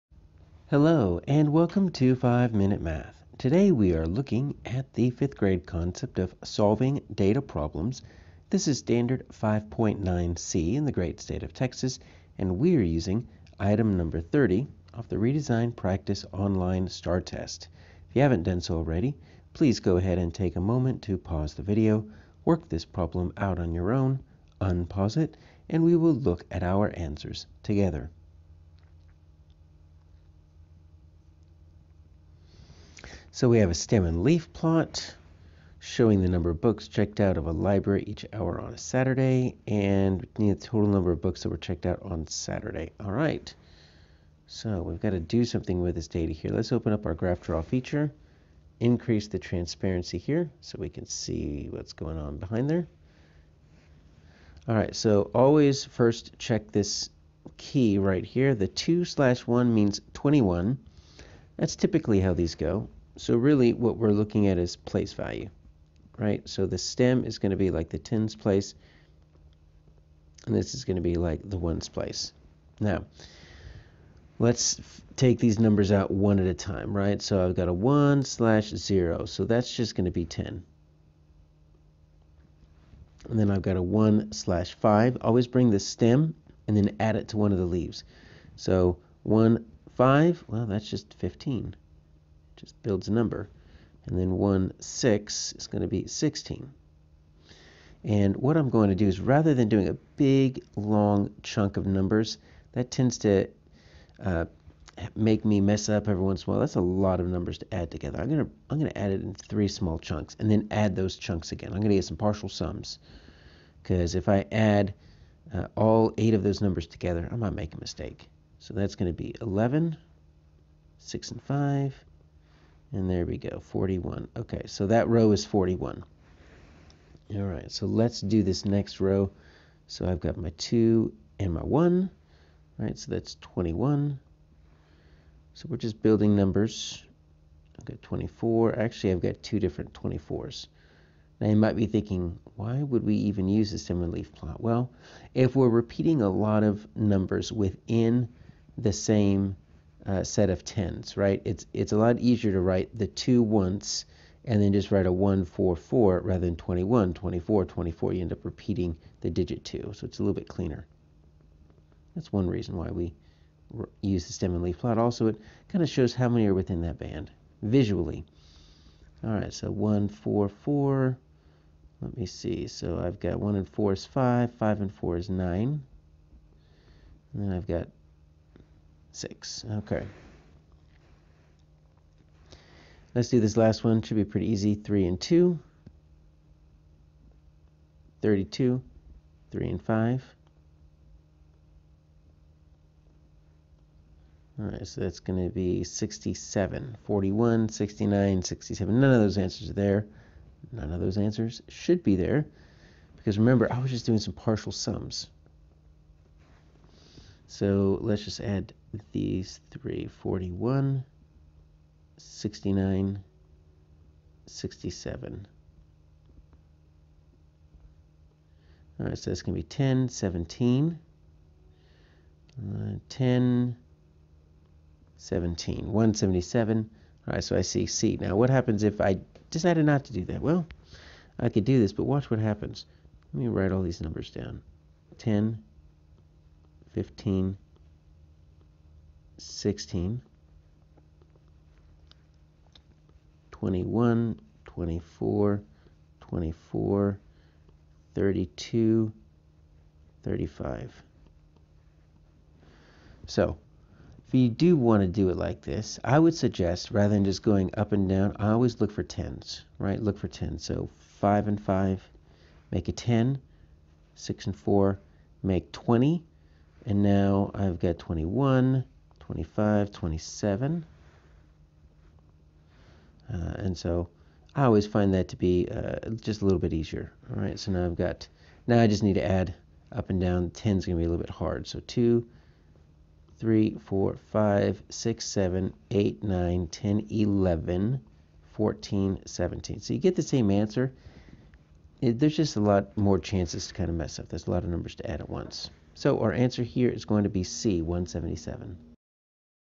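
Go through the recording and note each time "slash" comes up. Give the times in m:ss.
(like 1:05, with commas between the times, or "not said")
0:59, 1:18, 1:24.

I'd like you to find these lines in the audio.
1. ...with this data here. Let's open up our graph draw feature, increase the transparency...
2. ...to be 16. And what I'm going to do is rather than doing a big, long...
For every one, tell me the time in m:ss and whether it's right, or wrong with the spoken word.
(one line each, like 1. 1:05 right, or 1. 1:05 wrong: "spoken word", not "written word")
1. 0:45 right
2. 1:35 right.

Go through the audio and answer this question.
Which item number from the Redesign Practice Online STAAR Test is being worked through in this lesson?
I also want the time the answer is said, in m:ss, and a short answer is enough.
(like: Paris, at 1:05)
30, at 0:14.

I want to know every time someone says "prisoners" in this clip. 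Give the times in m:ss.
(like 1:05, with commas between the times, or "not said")
not said.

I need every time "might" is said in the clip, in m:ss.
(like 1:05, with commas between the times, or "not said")
1:57, 2:21.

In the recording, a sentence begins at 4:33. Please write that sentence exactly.
Uh, and so I always find that to be uh, just a little bit easier.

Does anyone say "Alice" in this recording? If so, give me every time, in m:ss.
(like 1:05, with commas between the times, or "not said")
not said.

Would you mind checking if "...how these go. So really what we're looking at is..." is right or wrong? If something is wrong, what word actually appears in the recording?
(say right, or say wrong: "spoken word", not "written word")
right.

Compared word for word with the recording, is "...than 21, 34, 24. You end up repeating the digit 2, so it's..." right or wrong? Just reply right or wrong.
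wrong.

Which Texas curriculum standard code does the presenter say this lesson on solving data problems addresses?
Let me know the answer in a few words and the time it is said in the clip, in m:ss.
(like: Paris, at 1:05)
5.9c, at 0:09.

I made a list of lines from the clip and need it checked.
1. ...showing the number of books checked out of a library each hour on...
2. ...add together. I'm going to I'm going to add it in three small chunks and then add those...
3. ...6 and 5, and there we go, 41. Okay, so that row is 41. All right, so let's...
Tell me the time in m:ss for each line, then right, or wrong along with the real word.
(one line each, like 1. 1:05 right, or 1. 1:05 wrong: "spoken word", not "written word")
1. 0:35 right
2. 1:47 right
3. 2:00 right.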